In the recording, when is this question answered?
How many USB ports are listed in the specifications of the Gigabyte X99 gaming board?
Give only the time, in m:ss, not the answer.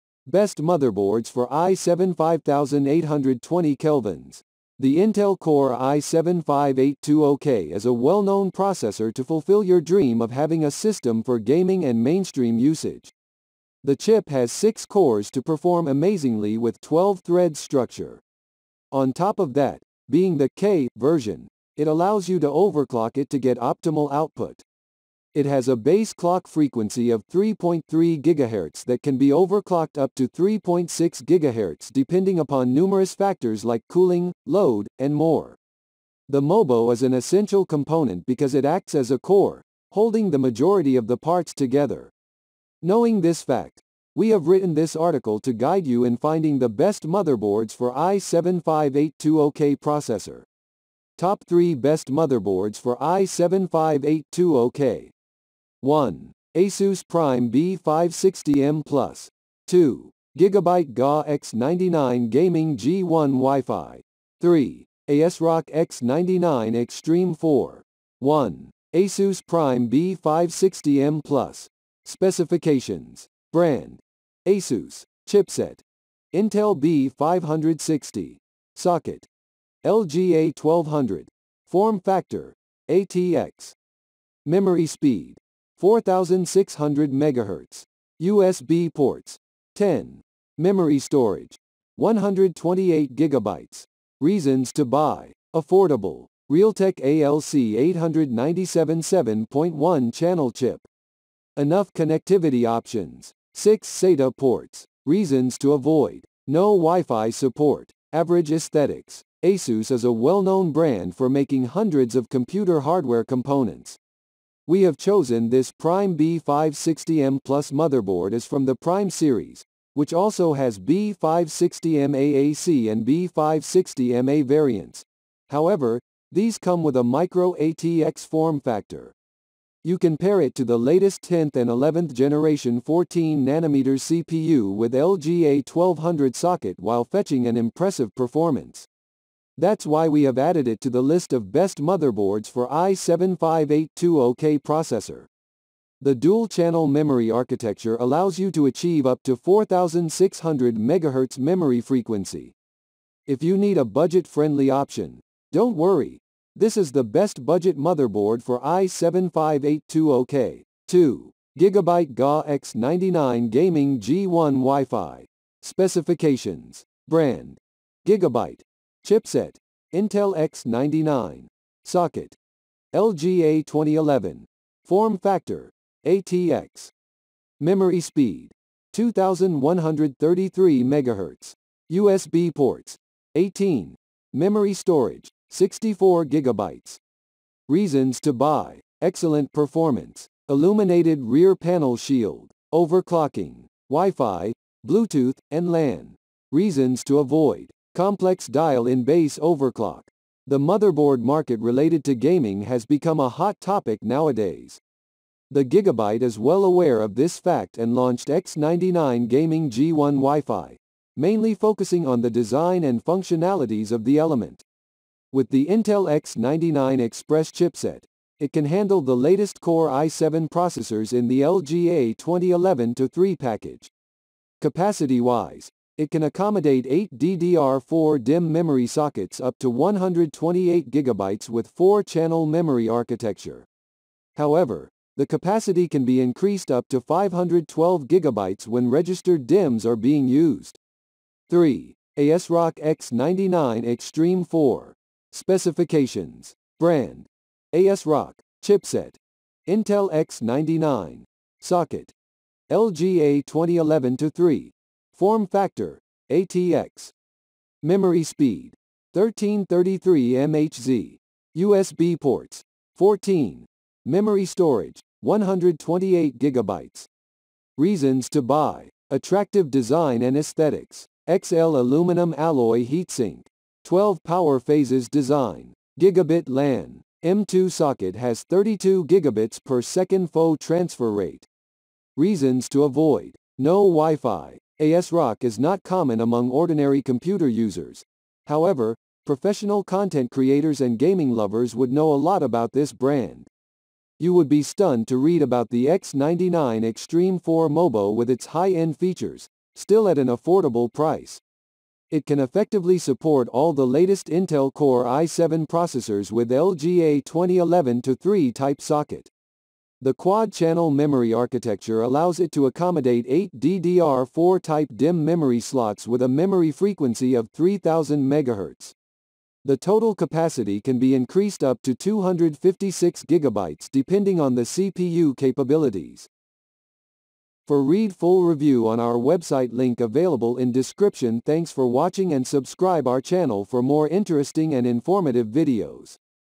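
3:03.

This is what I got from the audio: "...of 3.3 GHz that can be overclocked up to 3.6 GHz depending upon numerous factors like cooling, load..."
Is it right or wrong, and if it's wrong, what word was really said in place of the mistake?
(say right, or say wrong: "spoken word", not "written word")
right.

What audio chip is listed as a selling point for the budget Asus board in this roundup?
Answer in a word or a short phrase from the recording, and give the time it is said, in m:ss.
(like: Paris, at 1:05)
Realtek ALC 897, at 1:36.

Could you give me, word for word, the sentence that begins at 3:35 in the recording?
With the Intel X99 Express chipset, it can handle the latest Core i7 processors in the LGA 2011-3 package.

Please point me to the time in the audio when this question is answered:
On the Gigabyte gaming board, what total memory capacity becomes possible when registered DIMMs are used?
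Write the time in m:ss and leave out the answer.
3:57.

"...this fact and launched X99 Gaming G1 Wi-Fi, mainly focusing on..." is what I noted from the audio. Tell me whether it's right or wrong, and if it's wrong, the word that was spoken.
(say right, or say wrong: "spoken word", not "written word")
right.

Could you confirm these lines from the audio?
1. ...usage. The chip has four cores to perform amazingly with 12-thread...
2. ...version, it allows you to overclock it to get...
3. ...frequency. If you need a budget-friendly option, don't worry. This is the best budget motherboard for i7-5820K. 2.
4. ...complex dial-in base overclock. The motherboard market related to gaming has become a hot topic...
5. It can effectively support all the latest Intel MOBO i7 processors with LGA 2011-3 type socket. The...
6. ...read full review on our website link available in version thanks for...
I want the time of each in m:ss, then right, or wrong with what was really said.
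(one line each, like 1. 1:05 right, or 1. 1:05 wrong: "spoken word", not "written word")
1. 0:12 wrong: "six", not "four"
2. 0:20 right
3. 2:31 right
4. 3:18 right
5. 5:02 wrong: "Core", not "MOBO"
6. 5:27 wrong: "description", not "version".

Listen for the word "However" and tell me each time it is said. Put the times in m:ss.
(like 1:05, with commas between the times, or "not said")
2:05, 3:54, 4:48.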